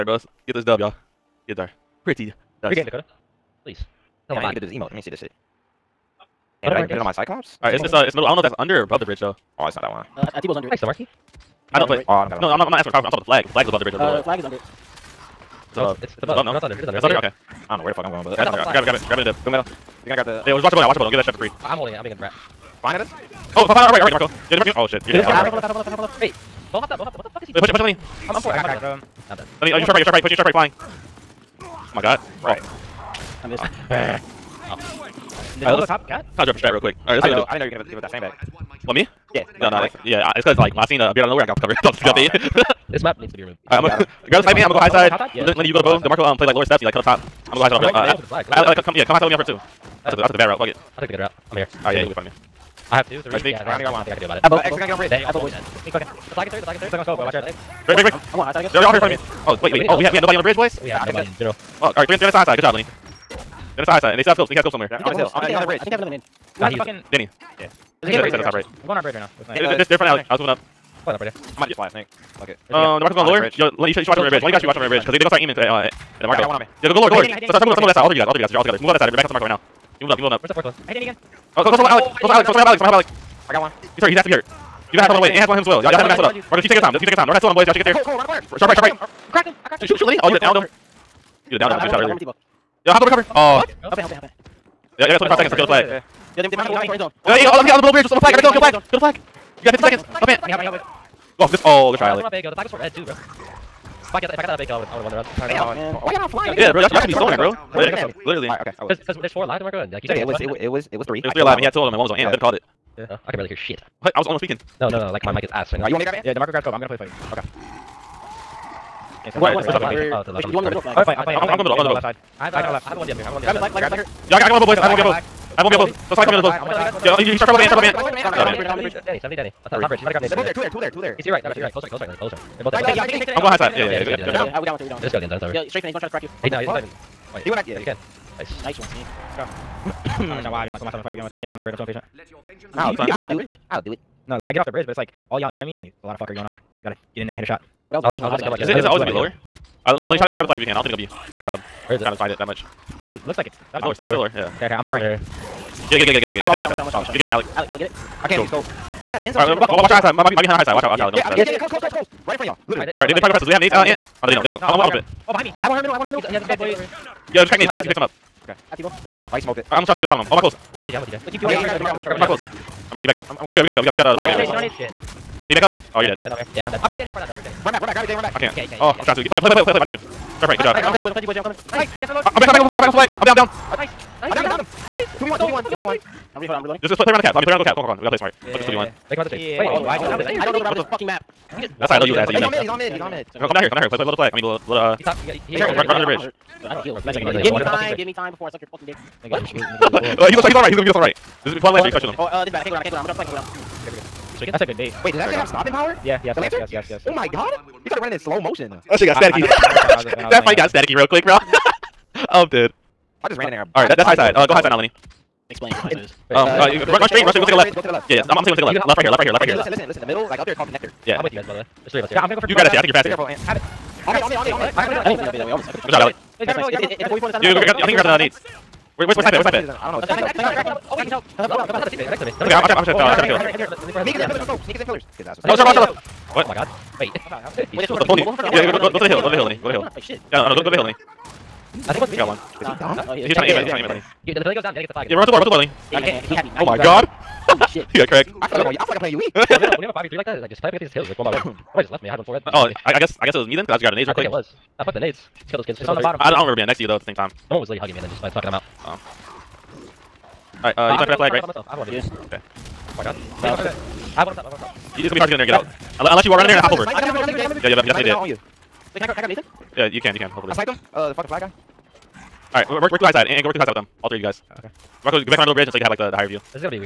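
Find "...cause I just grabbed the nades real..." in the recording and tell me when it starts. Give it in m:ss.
4:13.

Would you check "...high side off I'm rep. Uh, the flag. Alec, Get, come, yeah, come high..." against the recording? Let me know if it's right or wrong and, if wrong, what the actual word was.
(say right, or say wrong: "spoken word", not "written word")
wrong: "Alec", not "Get".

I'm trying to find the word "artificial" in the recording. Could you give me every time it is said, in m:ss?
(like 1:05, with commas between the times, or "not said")
not said.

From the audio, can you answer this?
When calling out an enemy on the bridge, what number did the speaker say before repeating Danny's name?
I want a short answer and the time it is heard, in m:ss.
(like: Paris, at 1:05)
70, at 2:09.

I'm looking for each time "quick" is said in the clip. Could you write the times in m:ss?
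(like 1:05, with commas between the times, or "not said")
0:36, 3:31, 4:14.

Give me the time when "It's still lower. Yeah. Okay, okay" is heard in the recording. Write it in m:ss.
2:34.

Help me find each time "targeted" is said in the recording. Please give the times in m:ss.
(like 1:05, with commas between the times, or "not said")
not said.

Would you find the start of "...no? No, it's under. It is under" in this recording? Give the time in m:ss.
0:16.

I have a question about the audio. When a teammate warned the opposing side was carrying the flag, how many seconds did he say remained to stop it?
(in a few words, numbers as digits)
25 seconds.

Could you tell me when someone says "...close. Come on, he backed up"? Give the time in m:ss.
2:52.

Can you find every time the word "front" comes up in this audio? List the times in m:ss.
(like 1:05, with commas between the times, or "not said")
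0:52, 0:58, 1:09, 2:25, 2:42, 3:58.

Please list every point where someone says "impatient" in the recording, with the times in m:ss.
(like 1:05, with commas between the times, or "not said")
2:21.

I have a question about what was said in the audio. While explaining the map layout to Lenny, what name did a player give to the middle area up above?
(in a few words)
Connector.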